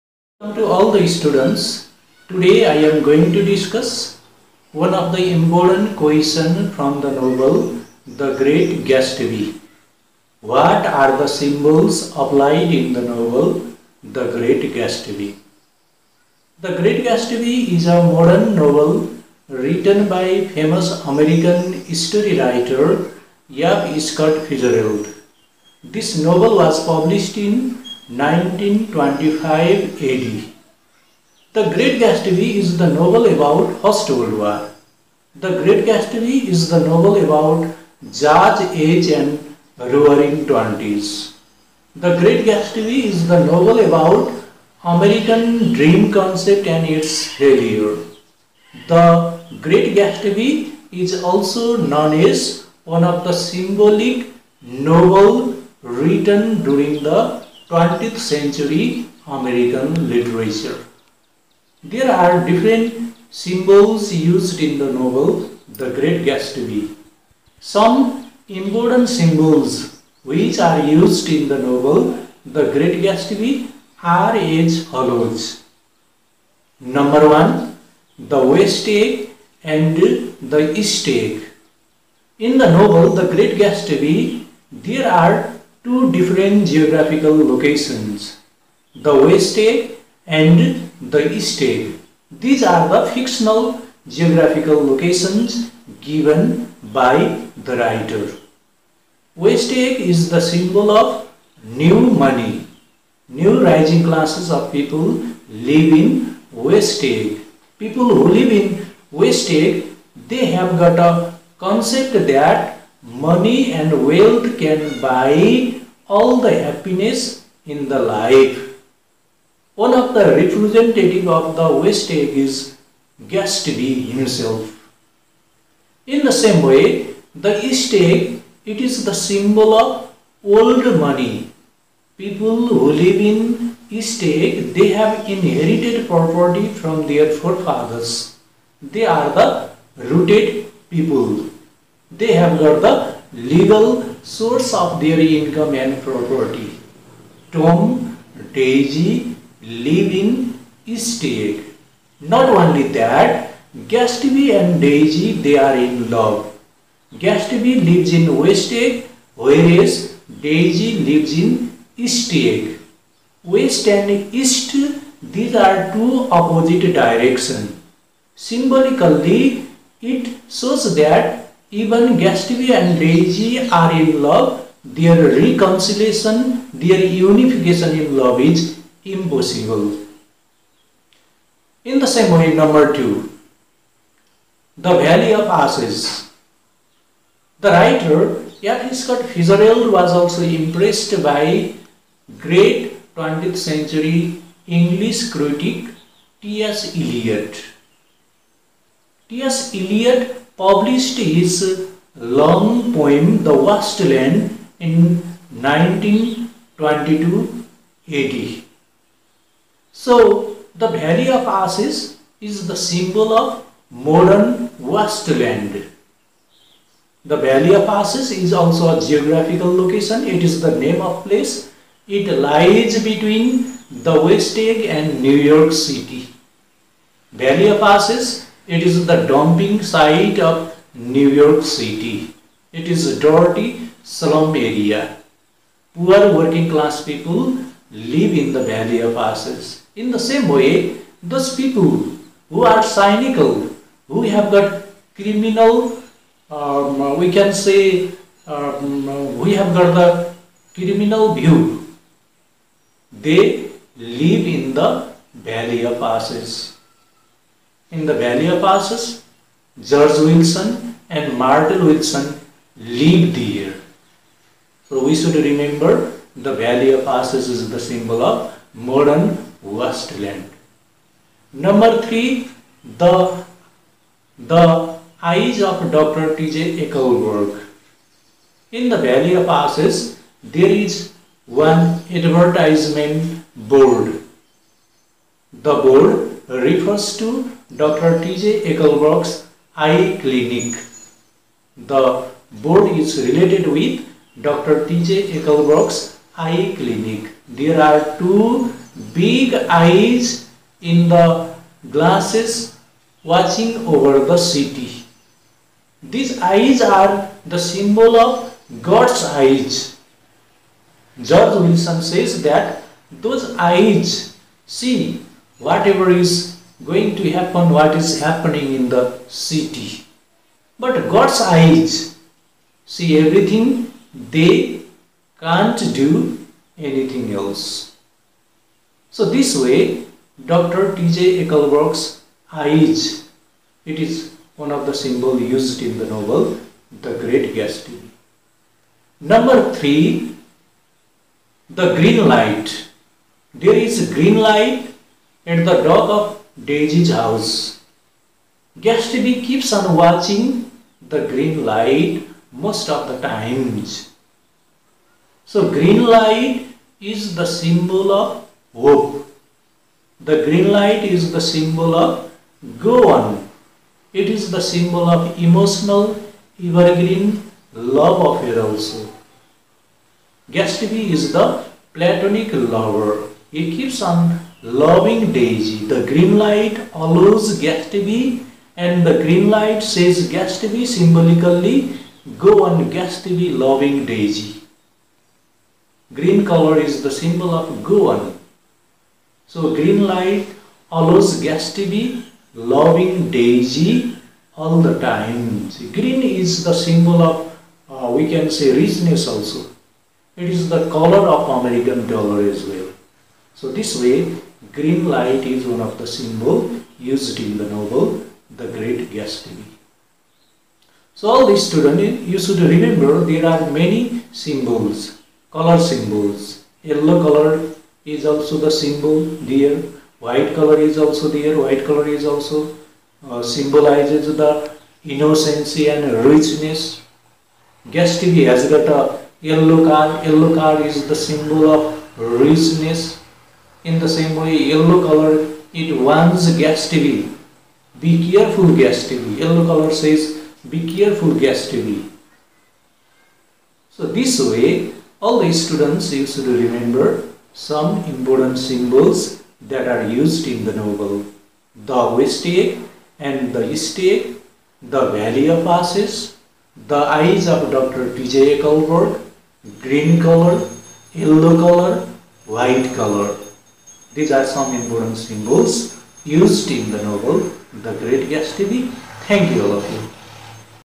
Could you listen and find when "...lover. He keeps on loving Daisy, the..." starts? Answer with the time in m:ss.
6:12.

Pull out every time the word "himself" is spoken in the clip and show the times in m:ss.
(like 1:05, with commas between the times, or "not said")
2:04.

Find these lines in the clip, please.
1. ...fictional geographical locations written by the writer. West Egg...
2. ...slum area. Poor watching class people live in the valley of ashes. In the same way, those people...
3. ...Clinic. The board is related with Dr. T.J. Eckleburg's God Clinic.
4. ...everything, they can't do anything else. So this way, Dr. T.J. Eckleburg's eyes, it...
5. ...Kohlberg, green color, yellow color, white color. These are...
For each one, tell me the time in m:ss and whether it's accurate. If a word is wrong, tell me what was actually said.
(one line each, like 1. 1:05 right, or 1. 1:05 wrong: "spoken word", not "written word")
1. 1:33 wrong: "given", not "written"
2. 3:54 wrong: "working", not "watching"
3. 4:50 wrong: "Eye", not "God"
4. 5:23 right
5. 7:38 right.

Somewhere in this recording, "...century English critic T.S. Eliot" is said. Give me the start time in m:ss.
3:13.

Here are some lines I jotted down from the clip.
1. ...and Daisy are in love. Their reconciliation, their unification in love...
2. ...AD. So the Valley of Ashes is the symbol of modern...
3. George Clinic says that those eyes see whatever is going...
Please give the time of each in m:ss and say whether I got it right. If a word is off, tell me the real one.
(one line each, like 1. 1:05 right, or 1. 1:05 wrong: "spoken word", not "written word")
1. 2:52 right
2. 3:28 right
3. 5:11 wrong: "Wilson", not "Clinic".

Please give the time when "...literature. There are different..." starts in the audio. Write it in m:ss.
1:00.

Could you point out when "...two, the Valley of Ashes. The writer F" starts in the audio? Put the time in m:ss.
3:02.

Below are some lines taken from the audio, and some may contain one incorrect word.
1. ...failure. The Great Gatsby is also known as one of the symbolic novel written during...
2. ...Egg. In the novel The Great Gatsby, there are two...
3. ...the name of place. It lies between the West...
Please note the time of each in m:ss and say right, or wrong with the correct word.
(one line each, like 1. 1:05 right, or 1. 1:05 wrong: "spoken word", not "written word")
1. 0:47 right
2. 1:21 right
3. 3:40 right.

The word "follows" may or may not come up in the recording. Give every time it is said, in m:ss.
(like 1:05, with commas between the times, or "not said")
1:14.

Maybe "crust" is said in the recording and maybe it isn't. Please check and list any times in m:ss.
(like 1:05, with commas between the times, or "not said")
not said.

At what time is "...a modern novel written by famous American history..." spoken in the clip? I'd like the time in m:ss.
0:17.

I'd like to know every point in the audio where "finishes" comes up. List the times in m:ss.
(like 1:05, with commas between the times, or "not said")
not said.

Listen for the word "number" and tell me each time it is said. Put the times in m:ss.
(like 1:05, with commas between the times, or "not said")
1:16, 3:02, 4:31, 5:39.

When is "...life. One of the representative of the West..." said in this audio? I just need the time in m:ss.
1:57.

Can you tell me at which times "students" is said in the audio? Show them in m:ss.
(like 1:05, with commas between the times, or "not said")
0:01, 6:51, 7:25.